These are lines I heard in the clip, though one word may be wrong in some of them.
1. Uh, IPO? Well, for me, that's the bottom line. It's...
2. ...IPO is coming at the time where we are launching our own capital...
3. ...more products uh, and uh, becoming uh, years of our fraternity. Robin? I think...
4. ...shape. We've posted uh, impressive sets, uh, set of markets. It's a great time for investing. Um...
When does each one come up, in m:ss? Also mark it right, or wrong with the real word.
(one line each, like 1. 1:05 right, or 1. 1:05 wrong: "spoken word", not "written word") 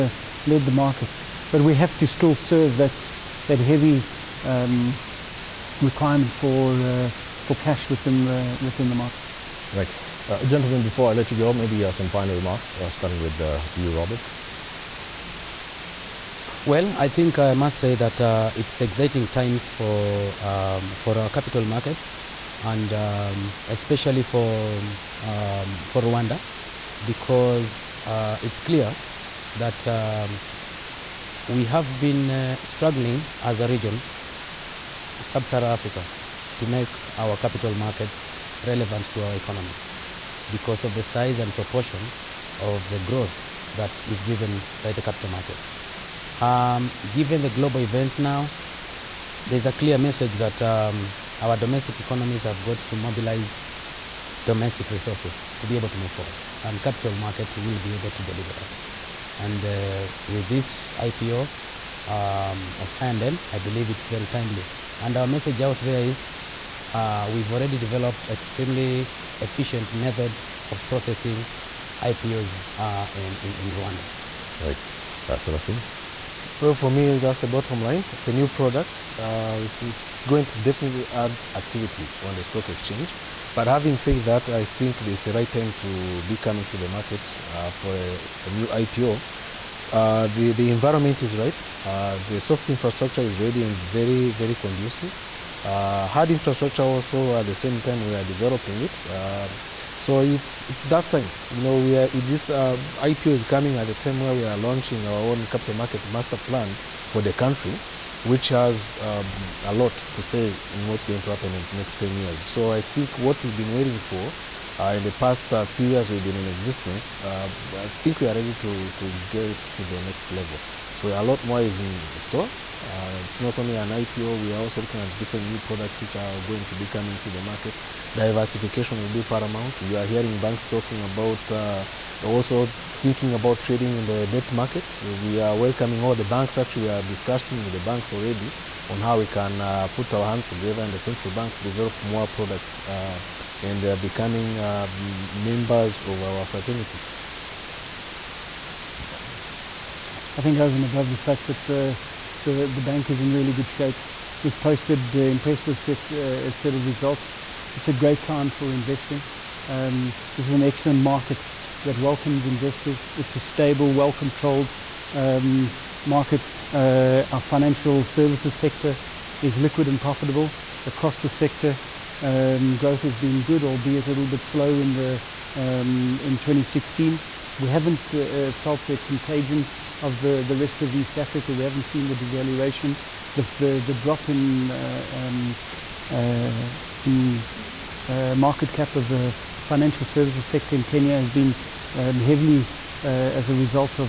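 1. 1:15 wrong: "Celestine", not "IPO"
2. 1:42 right
3. 2:22 wrong: "members", not "years"
4. 2:33 wrong: "results", not "markets".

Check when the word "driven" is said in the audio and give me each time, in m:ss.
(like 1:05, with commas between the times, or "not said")
0:44.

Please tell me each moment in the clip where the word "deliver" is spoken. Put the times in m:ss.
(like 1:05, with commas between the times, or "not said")
0:58.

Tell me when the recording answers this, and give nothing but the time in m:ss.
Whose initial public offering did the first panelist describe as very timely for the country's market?
1:03.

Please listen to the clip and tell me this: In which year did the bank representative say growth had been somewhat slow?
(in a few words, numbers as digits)
2016.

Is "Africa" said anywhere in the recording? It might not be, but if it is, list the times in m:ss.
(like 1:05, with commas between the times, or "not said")
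0:35, 3:01.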